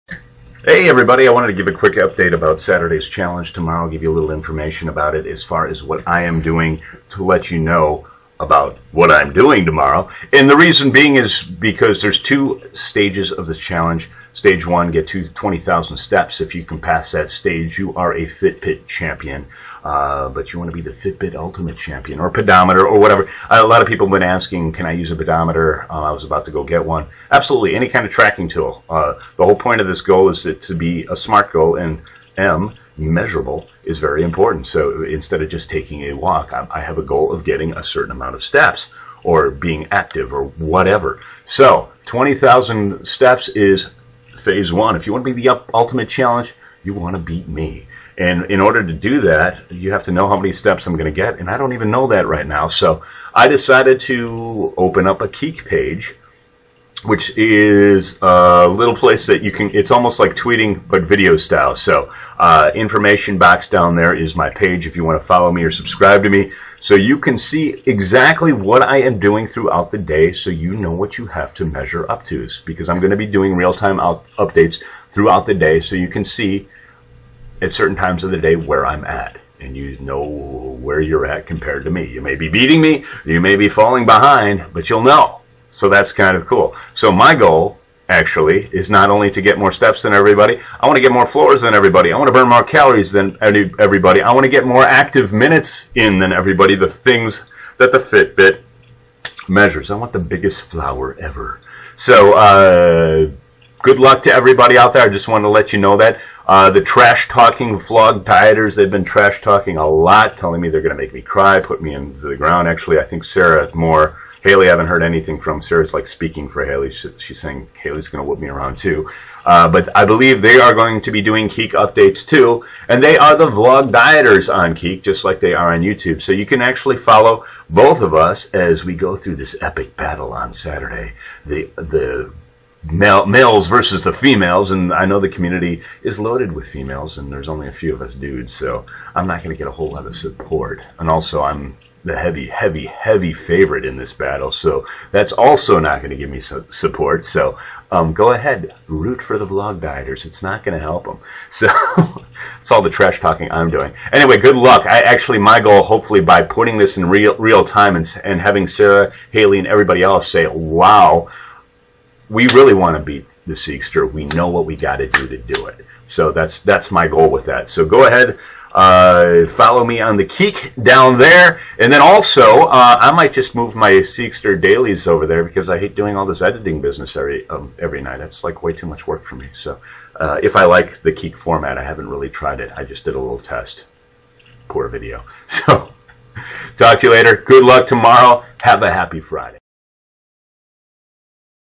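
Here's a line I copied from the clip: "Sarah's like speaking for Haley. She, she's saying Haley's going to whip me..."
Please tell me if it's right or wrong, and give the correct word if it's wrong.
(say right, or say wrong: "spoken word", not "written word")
right.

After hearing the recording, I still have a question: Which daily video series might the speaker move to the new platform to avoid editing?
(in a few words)
Siegster dailies.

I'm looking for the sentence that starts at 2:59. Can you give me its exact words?
So uh, if I like the Keek format, I haven't really tried it.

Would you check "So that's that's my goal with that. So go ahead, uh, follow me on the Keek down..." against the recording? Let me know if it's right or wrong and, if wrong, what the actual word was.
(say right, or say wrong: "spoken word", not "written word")
right.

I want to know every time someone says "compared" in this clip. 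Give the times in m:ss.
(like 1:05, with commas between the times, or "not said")
1:21.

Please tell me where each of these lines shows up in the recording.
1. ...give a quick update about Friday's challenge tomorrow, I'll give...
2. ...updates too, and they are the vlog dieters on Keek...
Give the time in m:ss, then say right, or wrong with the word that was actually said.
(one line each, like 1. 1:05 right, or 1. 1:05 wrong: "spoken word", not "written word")
1. 0:01 wrong: "Saturday", not "Friday"
2. 2:01 right.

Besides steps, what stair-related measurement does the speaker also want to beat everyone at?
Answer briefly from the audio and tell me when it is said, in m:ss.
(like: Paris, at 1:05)
floors, at 1:31.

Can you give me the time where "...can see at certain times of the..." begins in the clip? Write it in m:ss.
1:16.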